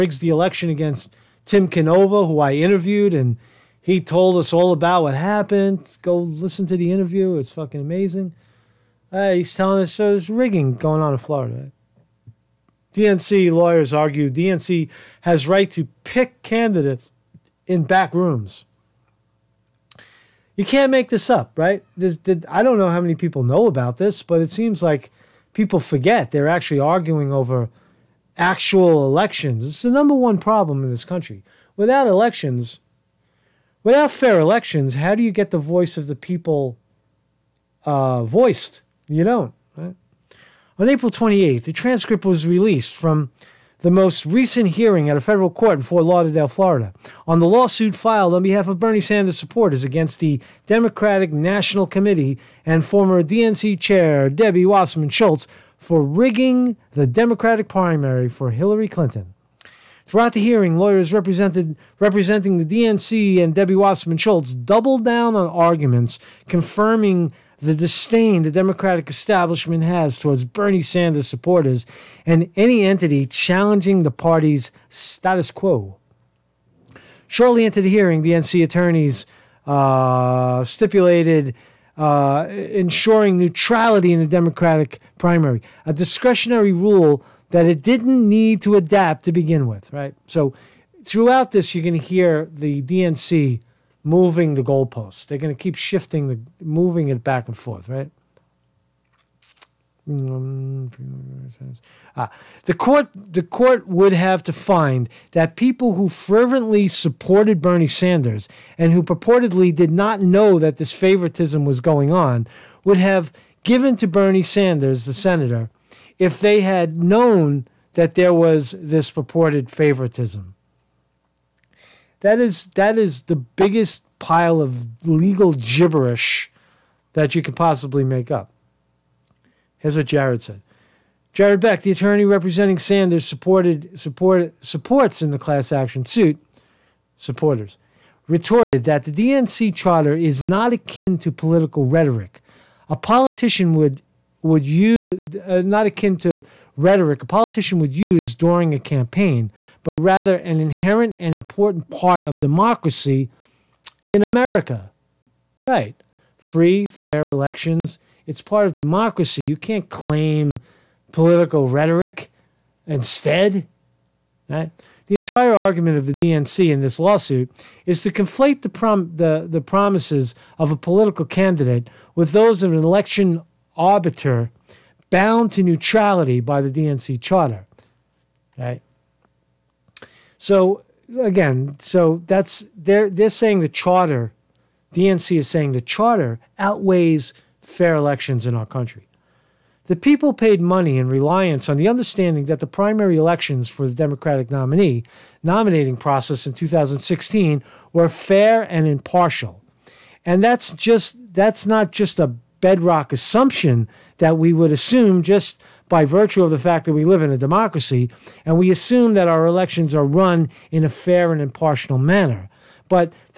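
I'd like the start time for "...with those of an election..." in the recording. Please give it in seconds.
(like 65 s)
172 s.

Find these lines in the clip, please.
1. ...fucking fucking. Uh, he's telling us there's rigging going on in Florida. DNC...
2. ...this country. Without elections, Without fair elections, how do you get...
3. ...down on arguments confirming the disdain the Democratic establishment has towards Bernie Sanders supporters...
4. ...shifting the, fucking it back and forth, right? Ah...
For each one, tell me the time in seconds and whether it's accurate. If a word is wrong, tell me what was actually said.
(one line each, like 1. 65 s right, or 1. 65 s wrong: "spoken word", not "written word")
1. 7 s wrong: "amazing", not "fucking"
2. 30 s right
3. 65 s right
4. 95 s wrong: "moving", not "fucking".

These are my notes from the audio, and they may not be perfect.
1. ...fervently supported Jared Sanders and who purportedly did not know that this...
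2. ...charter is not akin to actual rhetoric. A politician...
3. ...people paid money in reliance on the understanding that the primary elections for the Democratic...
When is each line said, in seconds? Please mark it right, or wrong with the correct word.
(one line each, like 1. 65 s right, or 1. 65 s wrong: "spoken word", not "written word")
1. 106 s wrong: "Bernie", not "Jared"
2. 139 s wrong: "political", not "actual"
3. 189 s right.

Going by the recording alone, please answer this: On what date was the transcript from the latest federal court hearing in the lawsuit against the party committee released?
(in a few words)
April 28th.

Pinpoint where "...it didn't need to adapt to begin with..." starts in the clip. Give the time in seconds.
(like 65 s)
87 s.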